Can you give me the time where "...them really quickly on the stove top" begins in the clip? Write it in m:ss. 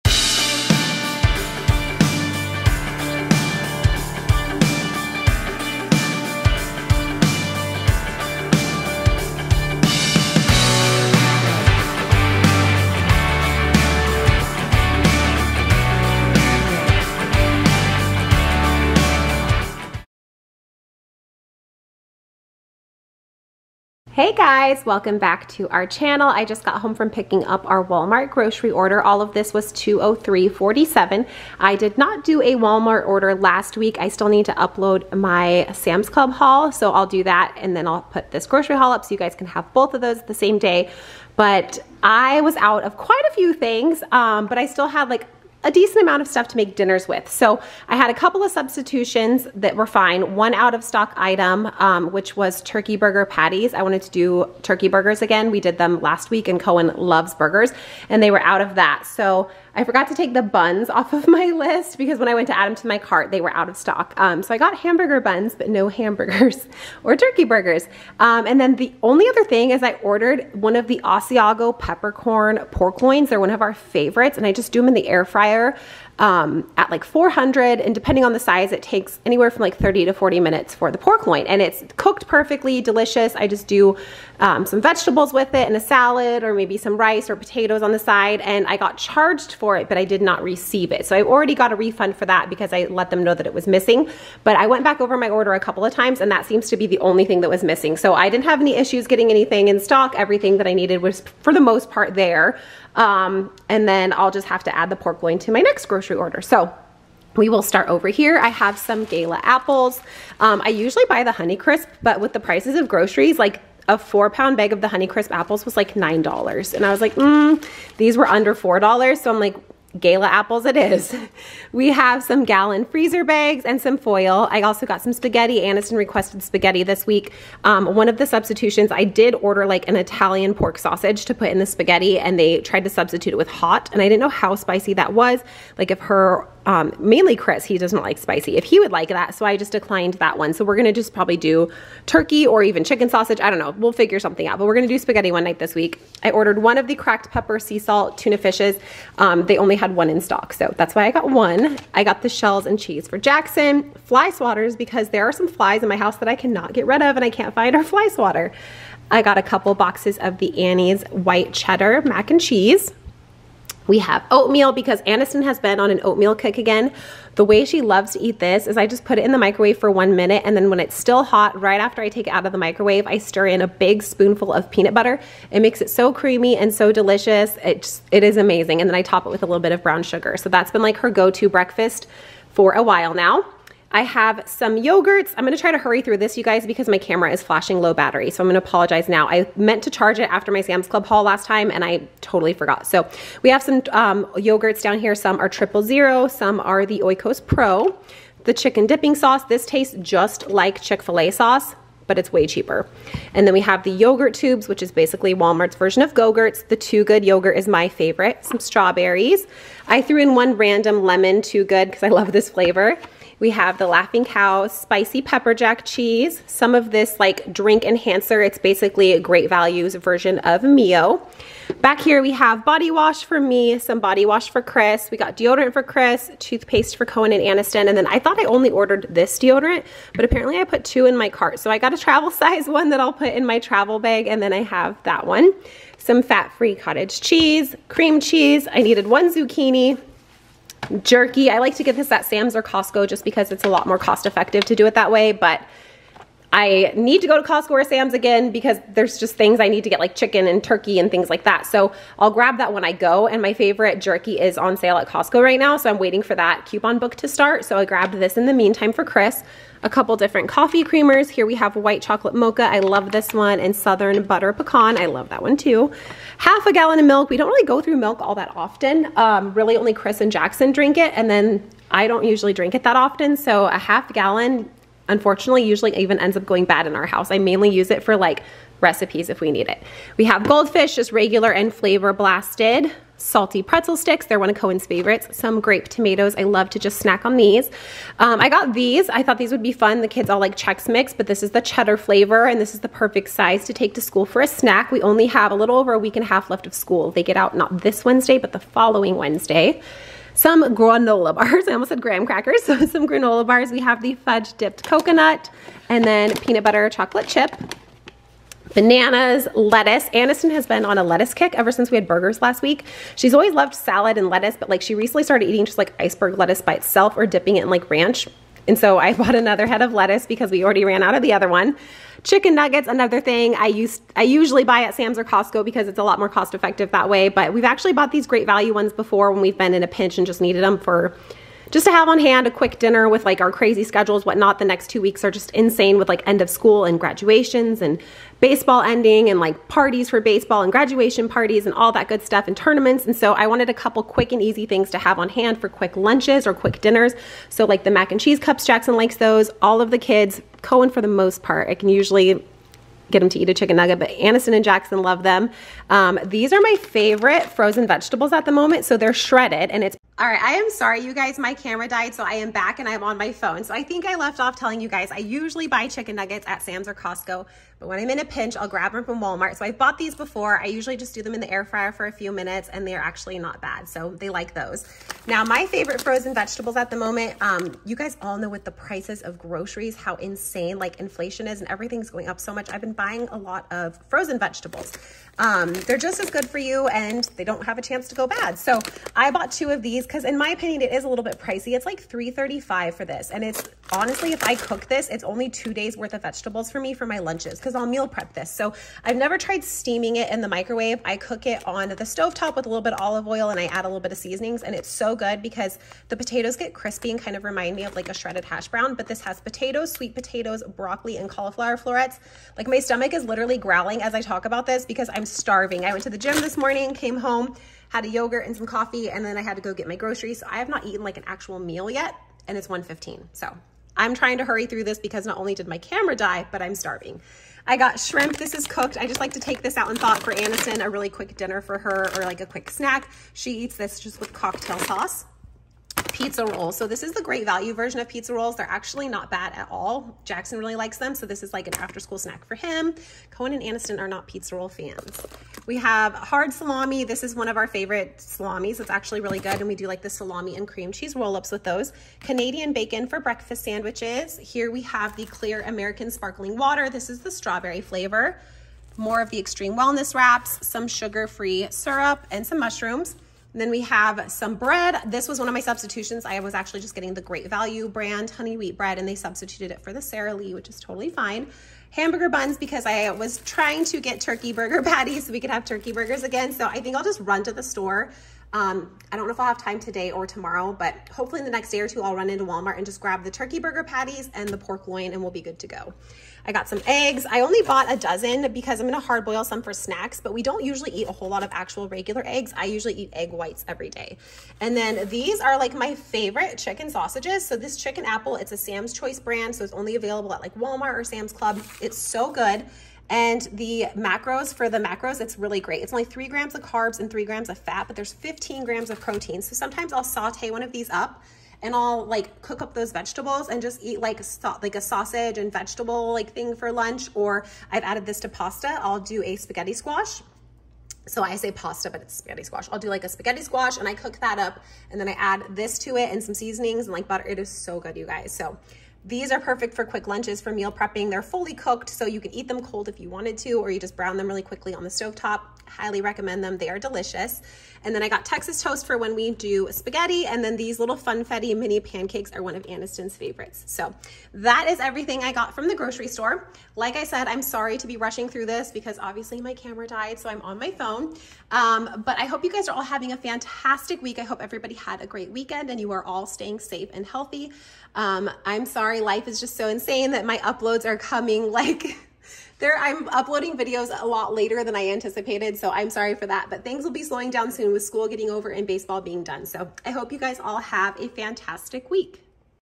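8:54.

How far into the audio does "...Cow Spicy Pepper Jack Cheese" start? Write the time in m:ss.
3:34.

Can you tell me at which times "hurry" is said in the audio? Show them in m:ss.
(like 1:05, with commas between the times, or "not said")
3:05, 7:04.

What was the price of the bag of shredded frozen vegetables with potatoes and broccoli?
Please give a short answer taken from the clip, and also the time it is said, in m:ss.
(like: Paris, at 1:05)
$3.35, at 6:31.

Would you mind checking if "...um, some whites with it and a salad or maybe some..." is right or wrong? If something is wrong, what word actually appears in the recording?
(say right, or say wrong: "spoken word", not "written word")
wrong: "vegetables", not "whites".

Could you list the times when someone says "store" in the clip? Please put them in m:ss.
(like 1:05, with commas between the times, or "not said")
7:57, 9:06.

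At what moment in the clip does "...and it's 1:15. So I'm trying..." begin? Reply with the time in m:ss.
7:02.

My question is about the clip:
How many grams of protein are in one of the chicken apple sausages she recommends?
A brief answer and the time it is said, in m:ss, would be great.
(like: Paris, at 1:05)
15, at 8:28.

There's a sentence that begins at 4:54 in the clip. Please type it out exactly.
We only have a little over a week and a half left of school.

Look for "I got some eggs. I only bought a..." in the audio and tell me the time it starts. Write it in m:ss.
8:06.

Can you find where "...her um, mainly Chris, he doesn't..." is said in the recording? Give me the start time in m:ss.
2:15.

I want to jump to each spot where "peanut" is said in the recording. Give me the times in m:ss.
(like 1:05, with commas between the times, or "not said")
2:54, 5:06.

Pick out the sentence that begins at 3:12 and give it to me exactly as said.
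So we have some um, yogurts down here.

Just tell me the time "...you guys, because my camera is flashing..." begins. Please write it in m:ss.
3:06.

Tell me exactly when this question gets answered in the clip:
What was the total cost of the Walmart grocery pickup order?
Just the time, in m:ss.
0:29.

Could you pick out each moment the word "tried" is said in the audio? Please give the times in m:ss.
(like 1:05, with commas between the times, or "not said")
2:12, 6:39.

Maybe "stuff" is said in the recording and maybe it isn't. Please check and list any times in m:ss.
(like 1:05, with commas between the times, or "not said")
0:46, 5:42.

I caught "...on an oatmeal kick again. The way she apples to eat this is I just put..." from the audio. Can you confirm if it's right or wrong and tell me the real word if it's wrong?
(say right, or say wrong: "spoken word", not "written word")
wrong: "loves", not "apples".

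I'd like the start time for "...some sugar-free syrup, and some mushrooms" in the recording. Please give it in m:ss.
7:40.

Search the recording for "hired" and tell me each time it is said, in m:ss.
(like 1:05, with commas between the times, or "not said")
not said.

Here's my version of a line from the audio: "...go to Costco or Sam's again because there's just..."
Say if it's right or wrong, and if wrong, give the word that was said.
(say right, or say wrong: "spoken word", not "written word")
right.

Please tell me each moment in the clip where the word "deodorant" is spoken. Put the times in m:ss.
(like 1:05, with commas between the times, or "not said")
3:45, 3:49.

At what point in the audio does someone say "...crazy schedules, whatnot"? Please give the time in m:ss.
5:33.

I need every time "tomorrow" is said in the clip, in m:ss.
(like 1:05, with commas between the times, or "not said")
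8:00.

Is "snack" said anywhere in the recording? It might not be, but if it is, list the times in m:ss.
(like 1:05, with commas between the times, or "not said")
4:46, 4:54, 7:12, 7:22, 8:09.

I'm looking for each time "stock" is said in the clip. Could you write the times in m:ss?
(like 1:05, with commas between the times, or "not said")
0:50, 1:03, 1:39, 2:30.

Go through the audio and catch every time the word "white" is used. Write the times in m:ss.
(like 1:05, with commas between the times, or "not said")
2:41, 4:21, 8:13.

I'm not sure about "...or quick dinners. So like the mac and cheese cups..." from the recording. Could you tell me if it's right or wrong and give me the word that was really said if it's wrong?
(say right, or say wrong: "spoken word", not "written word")
right.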